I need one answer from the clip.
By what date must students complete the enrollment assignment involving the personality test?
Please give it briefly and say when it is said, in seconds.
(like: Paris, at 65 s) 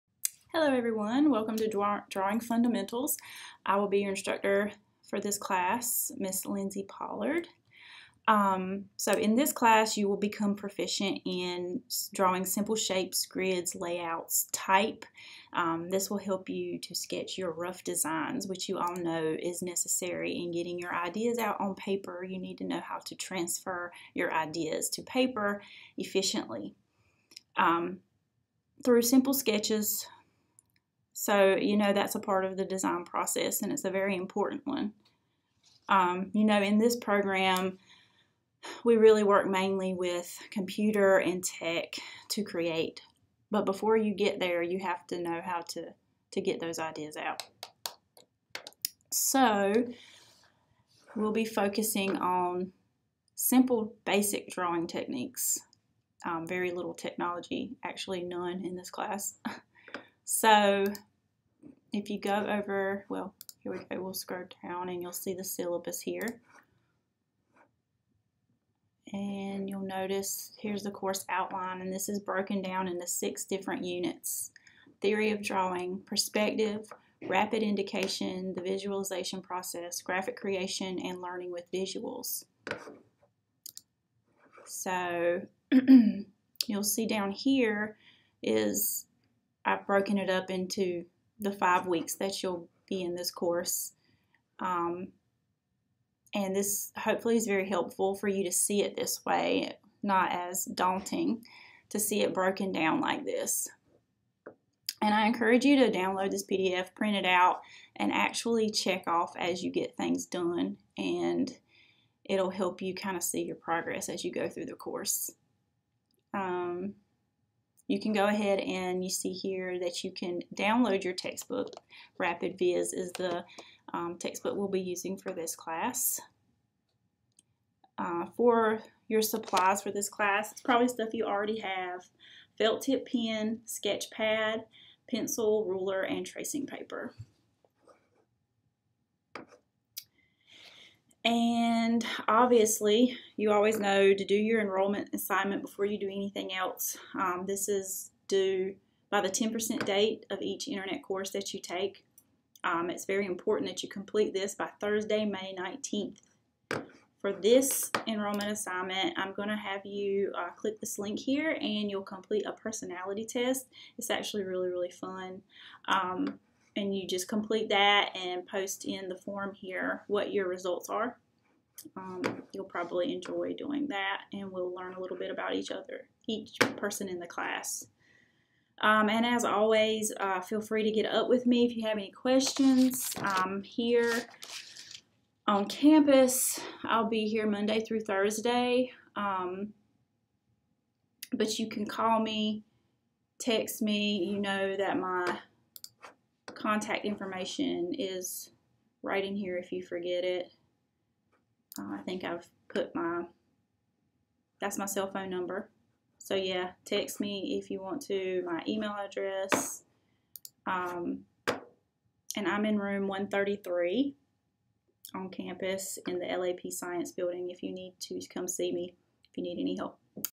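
Thursday, May 19th, at 154 s.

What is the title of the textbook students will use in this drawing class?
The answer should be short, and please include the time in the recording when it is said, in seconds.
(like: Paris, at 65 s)
Rapid Viz, at 122 s.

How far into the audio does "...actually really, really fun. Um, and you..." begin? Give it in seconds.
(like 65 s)
164 s.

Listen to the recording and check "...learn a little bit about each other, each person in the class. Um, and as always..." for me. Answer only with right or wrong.
right.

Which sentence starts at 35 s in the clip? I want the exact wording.
Um, you know, in this program, we really work mainly with computer and tech to create.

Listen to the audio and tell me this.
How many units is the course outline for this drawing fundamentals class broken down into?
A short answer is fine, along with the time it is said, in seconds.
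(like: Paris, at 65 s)
6, at 73 s.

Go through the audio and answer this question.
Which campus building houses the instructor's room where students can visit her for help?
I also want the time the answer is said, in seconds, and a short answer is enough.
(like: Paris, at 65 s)
LAP Science Building, at 216 s.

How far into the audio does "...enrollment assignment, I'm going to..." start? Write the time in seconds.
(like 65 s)
158 s.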